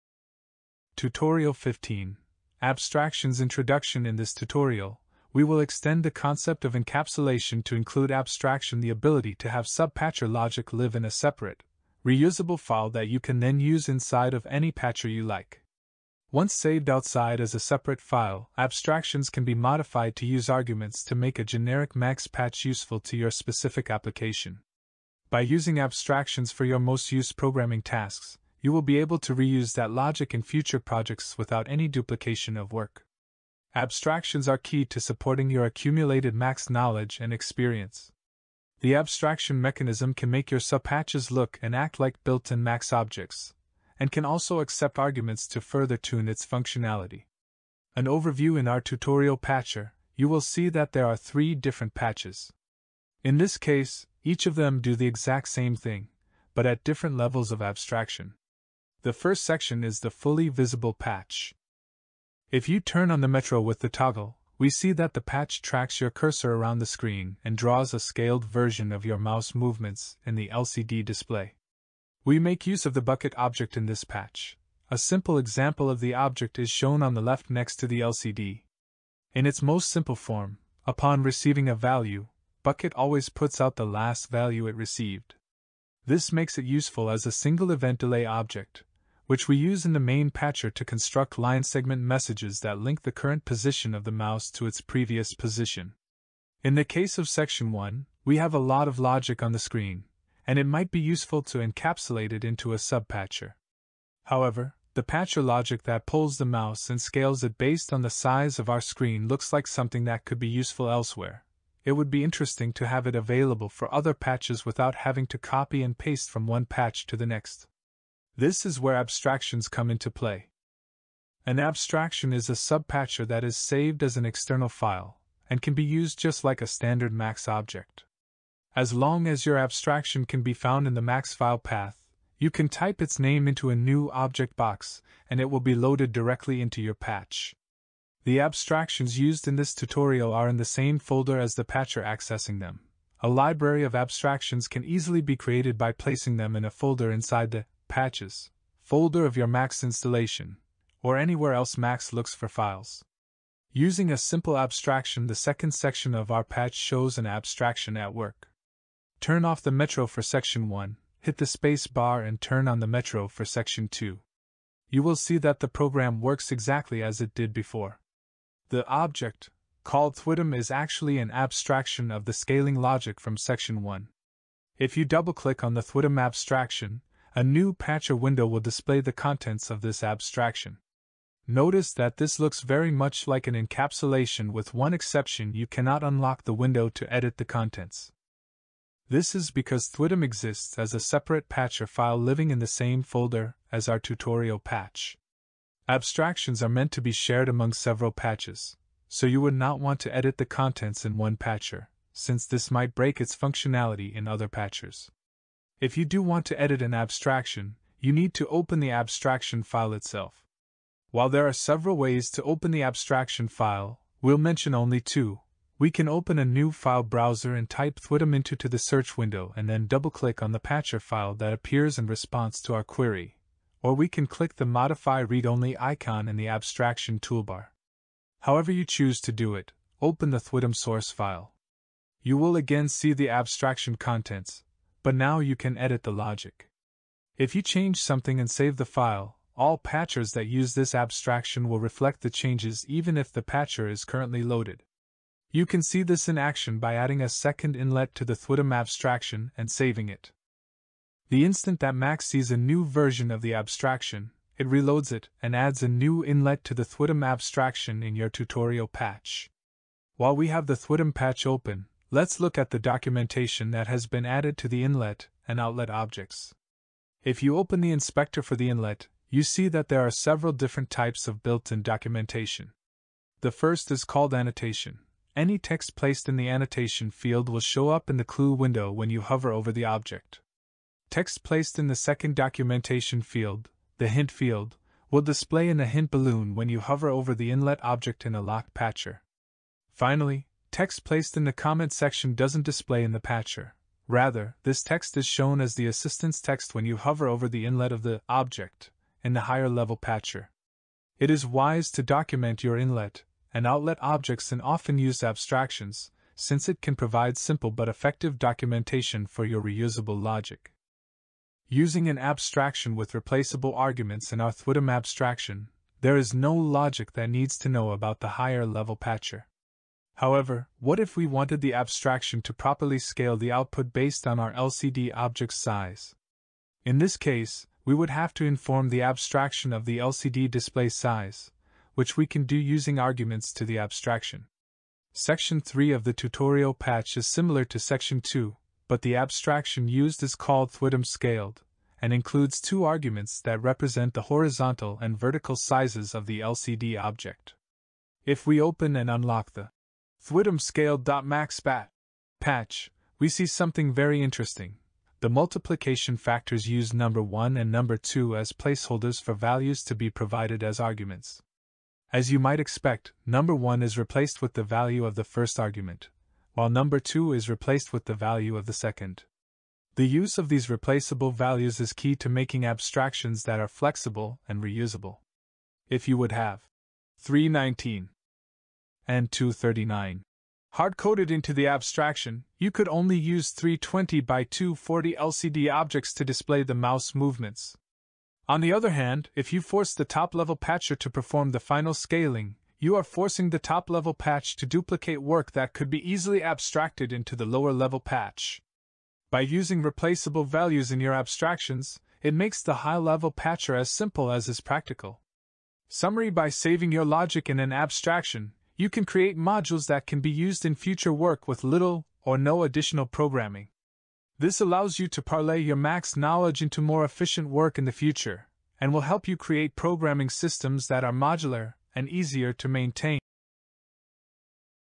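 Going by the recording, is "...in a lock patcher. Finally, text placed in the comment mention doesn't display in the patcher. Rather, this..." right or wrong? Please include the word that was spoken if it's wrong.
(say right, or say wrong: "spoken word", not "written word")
wrong: "section", not "mention".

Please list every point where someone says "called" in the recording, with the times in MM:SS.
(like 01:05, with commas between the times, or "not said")
02:49, 04:34, 05:40.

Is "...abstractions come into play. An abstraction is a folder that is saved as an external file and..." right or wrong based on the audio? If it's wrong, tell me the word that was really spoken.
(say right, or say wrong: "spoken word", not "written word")
wrong: "subpatcher", not "folder".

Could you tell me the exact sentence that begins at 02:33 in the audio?
Using a simple abstraction, the second section of our patch shows an abstraction at work.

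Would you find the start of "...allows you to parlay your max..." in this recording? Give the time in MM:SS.
06:54.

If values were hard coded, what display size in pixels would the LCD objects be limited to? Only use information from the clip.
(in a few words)
320 by 240.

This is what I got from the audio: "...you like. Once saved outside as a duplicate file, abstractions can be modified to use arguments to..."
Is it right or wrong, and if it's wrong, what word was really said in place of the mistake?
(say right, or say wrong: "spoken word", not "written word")
wrong: "separate", not "duplicate".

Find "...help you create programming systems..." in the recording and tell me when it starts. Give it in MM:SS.
06:59.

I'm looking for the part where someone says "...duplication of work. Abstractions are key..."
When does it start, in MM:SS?
00:31.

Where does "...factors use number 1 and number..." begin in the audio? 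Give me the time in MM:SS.
05:56.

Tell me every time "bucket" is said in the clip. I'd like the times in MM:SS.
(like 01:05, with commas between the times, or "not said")
01:13, 01:22.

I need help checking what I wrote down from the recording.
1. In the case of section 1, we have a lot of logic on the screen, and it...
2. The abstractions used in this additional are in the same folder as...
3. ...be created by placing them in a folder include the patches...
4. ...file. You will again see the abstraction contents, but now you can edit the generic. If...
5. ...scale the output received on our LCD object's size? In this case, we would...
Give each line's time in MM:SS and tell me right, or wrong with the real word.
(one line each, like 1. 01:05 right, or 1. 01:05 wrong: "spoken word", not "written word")
1. 01:36 right
2. 02:18 wrong: "tutorial", not "additional"
3. 02:25 wrong: "inside", not "include"
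4. 03:51 wrong: "logic", not "generic"
5. 05:22 wrong: "based", not "received".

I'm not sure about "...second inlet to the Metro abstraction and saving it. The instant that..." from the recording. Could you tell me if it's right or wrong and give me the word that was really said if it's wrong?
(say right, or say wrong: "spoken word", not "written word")
wrong: "Thwidom", not "Metro".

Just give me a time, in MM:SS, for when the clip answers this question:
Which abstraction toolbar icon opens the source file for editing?
03:44.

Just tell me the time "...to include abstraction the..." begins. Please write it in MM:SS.
00:07.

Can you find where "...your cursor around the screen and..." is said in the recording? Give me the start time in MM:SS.
01:05.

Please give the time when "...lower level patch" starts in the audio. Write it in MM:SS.
06:37.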